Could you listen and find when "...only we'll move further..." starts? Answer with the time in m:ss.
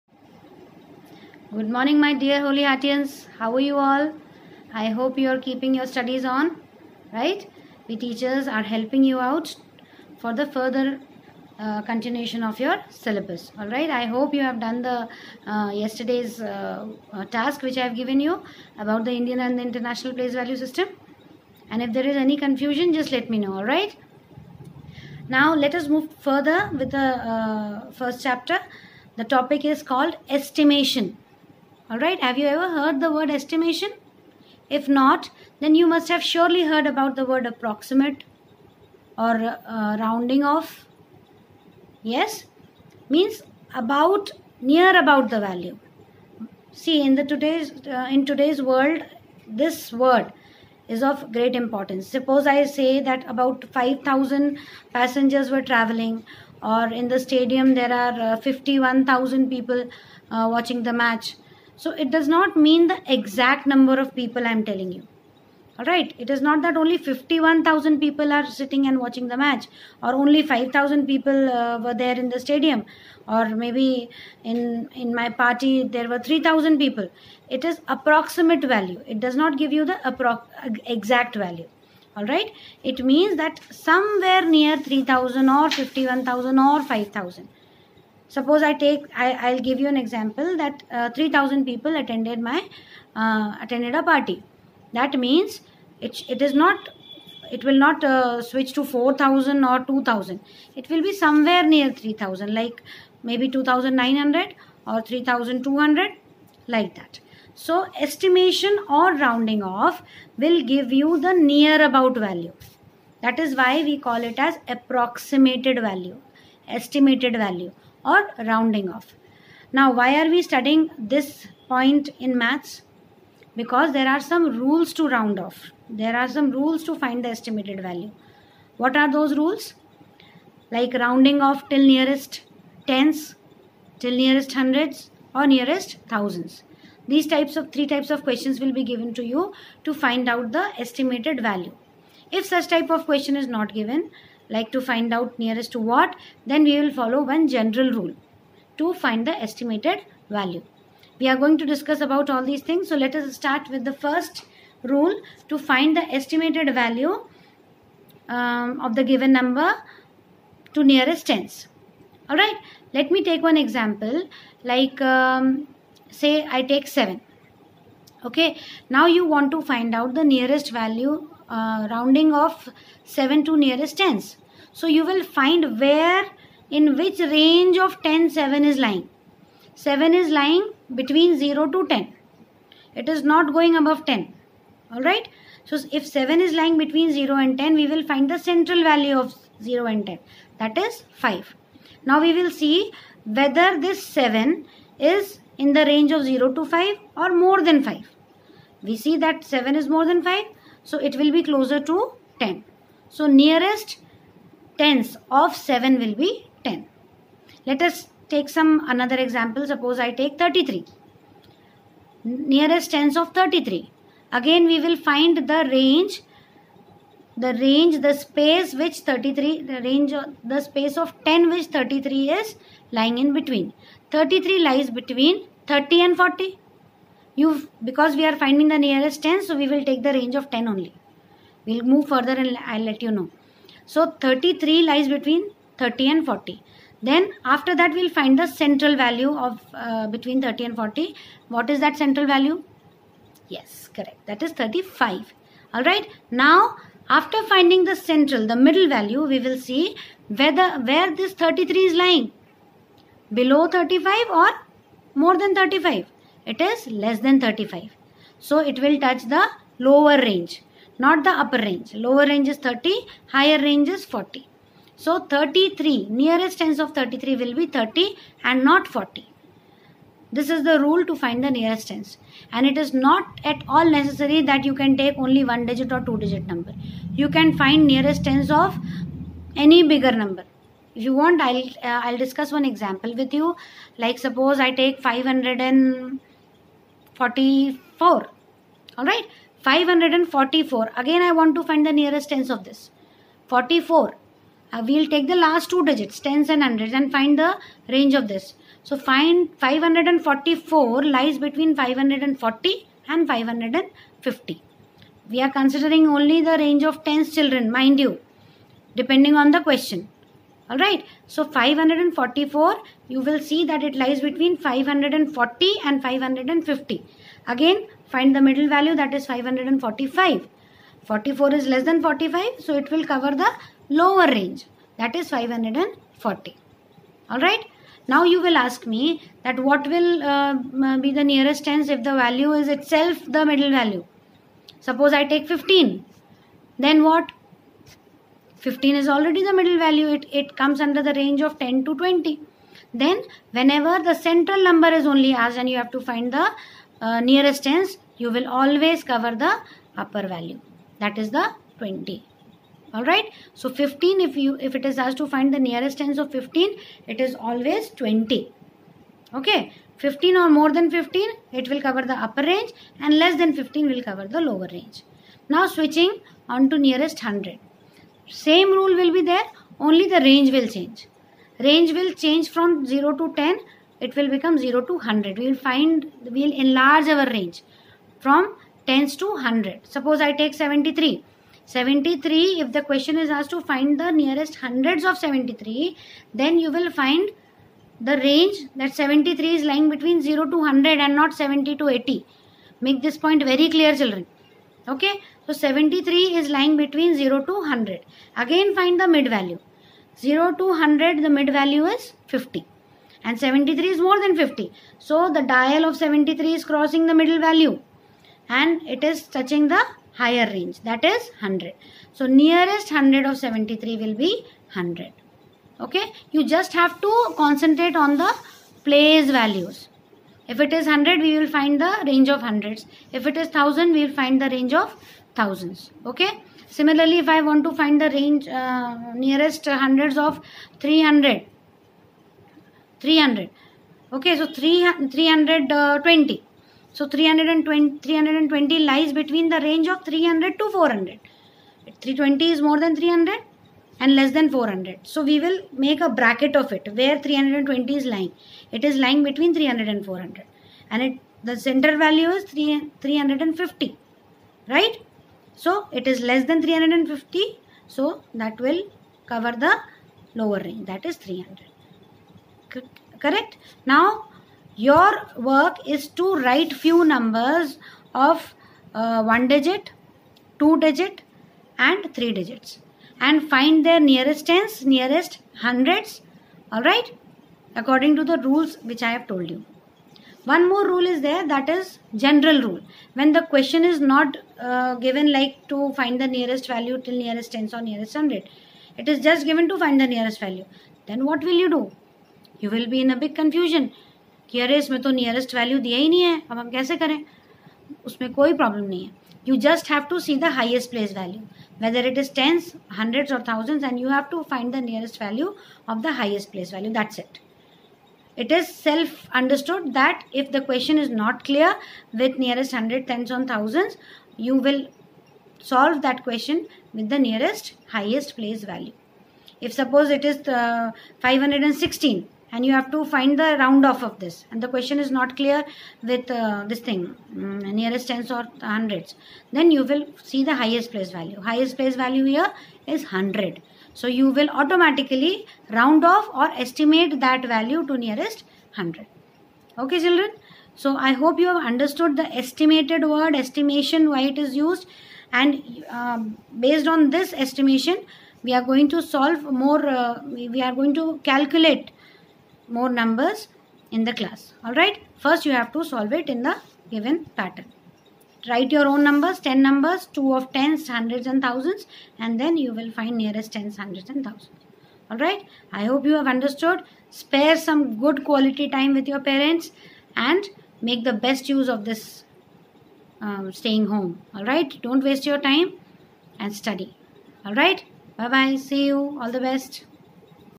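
3:50.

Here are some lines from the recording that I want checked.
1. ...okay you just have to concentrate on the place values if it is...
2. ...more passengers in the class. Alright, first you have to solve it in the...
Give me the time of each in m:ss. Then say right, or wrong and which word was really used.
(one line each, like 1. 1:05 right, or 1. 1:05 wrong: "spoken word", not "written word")
1. 6:55 right
2. 9:12 wrong: "numbers", not "passengers".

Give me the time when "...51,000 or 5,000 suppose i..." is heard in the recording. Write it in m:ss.
1:25.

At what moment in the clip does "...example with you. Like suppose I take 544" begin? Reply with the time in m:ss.
4:42.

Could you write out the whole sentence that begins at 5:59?
Okay, 15 or more than 15, it will cover the upper range and less than 15 will cover the lower range.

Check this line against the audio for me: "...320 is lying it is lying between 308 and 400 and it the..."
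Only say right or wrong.
wrong.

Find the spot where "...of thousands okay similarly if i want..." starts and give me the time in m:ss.
7:04.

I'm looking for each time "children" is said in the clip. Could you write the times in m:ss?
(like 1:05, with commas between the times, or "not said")
5:07, 6:34, 9:00.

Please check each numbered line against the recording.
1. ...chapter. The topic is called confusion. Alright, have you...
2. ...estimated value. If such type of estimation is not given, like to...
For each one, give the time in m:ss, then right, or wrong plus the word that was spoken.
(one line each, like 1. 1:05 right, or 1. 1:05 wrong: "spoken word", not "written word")
1. 0:28 wrong: "estimation", not "confusion"
2. 2:20 wrong: "question", not "estimation".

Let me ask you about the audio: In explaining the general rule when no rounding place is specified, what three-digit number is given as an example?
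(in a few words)
516.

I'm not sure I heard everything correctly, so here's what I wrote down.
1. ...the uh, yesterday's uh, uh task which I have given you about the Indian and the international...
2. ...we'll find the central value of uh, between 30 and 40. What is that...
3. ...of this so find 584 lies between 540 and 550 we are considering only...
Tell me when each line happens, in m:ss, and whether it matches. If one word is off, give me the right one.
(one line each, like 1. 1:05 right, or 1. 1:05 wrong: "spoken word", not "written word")
1. 0:14 right
2. 3:57 right
3. 4:58 wrong: "544", not "584".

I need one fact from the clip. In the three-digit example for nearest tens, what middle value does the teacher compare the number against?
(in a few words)
545.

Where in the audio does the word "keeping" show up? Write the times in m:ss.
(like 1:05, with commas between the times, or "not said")
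0:05.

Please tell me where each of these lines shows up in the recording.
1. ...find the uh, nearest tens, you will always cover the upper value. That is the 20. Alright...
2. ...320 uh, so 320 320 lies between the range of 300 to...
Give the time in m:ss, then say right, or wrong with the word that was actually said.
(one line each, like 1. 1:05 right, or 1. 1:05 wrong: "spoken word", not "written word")
1. 5:46 right
2. 7:15 right.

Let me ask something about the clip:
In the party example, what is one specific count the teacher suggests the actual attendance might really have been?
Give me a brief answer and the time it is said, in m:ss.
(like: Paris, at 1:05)
2900, at 1:43.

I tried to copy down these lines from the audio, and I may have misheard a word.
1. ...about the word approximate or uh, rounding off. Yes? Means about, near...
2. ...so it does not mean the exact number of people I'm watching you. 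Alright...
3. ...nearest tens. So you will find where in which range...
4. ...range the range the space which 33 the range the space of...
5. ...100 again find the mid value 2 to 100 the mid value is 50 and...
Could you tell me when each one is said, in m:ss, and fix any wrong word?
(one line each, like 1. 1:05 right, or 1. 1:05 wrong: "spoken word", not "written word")
1. 0:36 right
2. 1:01 wrong: "telling", not "watching"
3. 2:53 right
4. 3:35 right
5. 6:37 wrong: "0", not "2".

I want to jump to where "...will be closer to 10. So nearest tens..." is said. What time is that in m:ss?
3:21.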